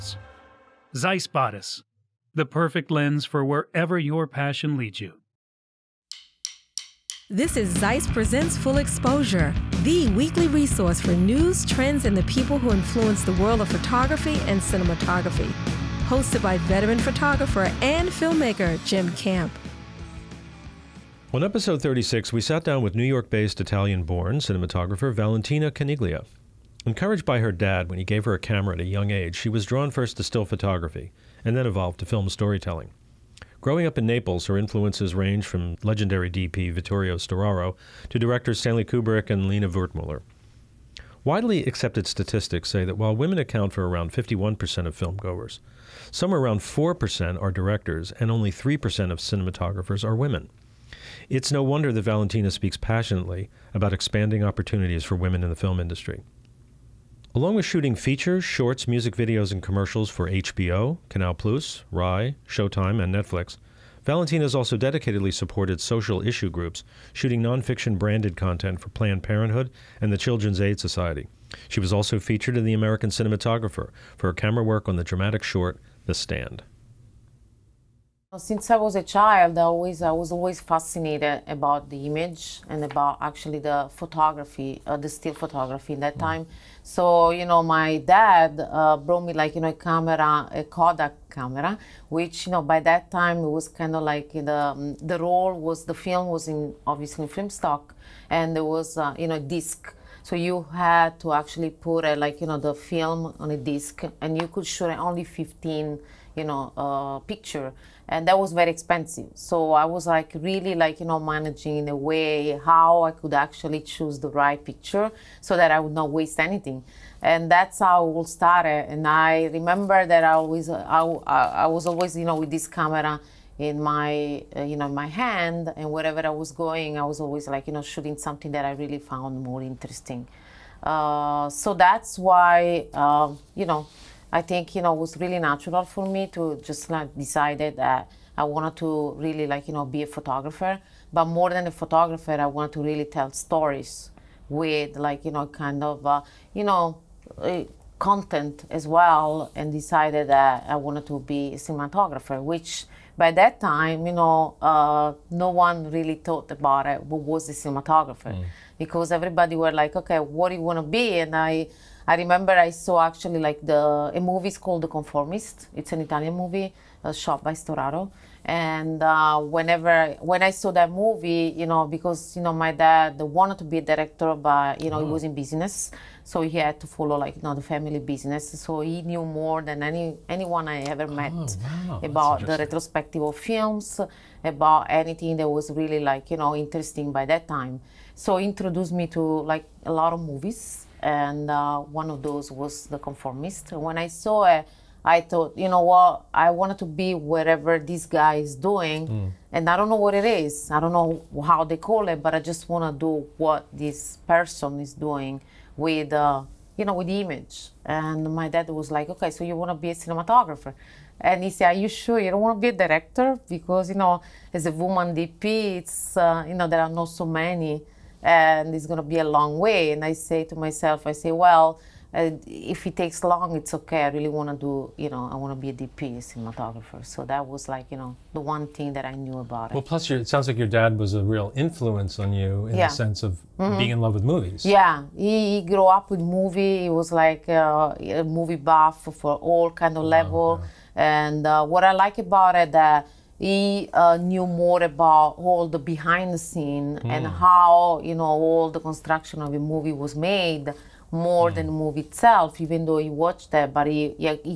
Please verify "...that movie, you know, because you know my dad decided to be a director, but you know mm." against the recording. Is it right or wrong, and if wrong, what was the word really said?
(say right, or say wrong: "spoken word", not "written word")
wrong: "wanted", not "decided".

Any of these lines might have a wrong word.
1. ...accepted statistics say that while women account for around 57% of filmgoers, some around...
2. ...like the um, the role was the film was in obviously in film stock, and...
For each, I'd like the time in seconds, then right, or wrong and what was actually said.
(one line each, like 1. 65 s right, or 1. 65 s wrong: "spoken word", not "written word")
1. 41 s wrong: "51", not "57"
2. 94 s right.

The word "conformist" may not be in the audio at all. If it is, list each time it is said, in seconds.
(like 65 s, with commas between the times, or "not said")
164 s, 192 s.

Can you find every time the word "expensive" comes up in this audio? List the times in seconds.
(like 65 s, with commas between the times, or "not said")
108 s.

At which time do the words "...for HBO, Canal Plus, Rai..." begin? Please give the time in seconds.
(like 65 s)
60 s.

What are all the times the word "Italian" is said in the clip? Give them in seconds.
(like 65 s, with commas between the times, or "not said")
23 s, 166 s.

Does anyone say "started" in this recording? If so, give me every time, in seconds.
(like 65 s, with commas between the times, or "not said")
118 s.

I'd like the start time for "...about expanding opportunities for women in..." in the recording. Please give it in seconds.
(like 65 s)
53 s.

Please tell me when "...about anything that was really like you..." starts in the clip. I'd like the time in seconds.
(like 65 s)
184 s.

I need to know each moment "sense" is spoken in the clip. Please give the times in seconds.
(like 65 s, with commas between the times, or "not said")
232 s.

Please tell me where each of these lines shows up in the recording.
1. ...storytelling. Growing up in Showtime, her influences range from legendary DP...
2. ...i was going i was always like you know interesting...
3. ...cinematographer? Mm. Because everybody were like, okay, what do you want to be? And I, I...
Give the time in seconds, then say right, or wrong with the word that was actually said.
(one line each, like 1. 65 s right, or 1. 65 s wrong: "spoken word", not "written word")
1. 32 s wrong: "Naples", not "Showtime"
2. 126 s wrong: "shooting", not "interesting"
3. 157 s right.